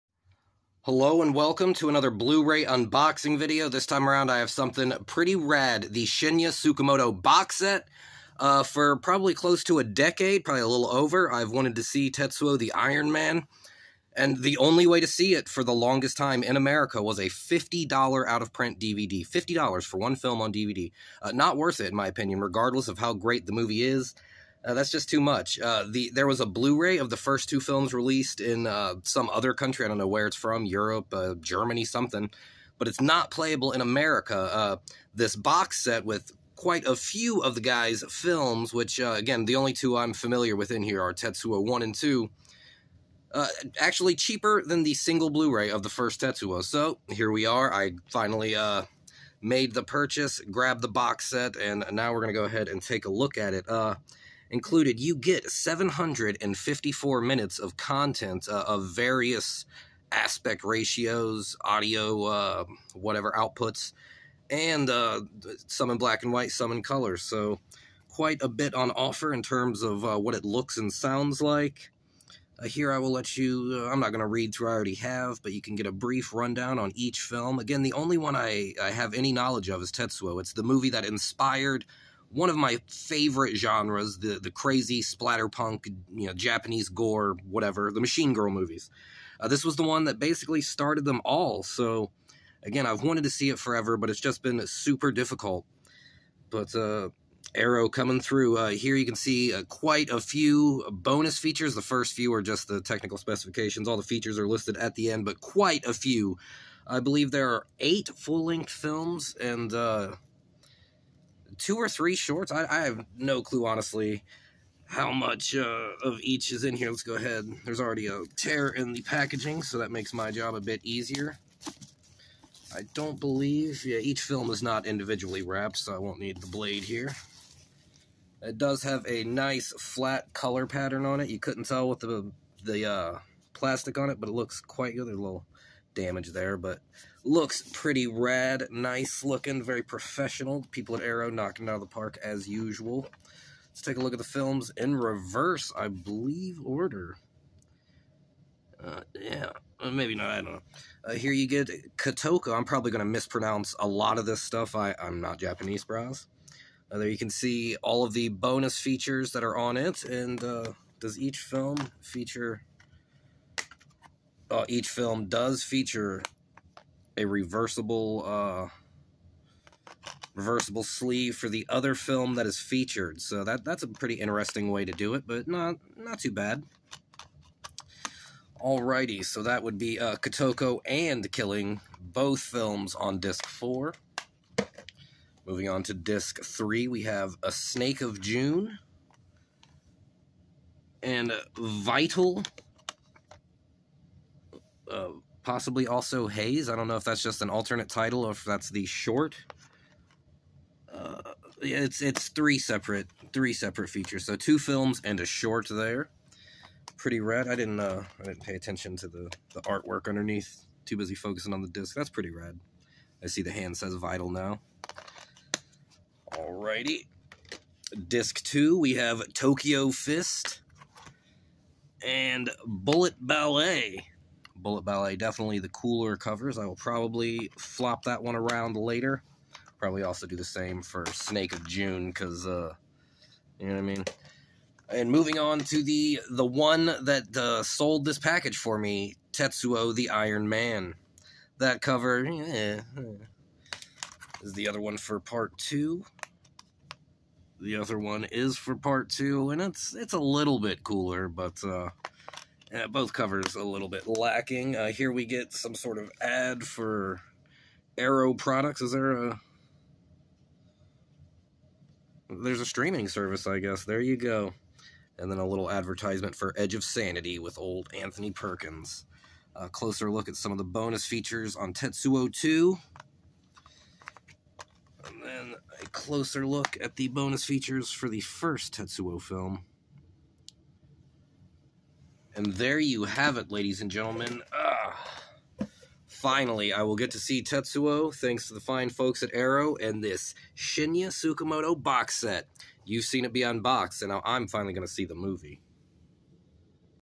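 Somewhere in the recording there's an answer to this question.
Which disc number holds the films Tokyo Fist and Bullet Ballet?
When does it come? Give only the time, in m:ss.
3:38.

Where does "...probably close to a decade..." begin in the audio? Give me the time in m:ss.
0:08.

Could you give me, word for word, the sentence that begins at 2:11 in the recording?
You couldn't tell with the the uh, plastic on it, but it looks quite good.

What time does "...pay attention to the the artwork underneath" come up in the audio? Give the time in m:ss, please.
3:28.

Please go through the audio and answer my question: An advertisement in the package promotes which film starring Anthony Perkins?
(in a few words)
Edge of Sanity.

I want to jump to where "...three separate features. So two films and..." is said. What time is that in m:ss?
3:23.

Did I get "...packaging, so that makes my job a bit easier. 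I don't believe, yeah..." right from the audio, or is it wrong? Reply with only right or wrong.
right.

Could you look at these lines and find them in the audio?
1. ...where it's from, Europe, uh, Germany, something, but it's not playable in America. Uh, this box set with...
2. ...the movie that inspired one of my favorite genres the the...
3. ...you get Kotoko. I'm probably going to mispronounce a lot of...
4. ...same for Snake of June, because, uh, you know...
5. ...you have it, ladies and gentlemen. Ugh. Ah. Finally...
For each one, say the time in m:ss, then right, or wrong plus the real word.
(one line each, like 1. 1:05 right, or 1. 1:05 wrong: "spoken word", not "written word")
1. 0:30 right
2. 1:20 right
3. 2:31 wrong: "Katoka", not "Kotoko"
4. 3:50 right
5. 4:42 right.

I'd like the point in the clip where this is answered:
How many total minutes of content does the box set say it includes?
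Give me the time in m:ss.
0:55.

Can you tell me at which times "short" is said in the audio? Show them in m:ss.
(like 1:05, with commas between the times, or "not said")
1:52, 3:18, 3:25.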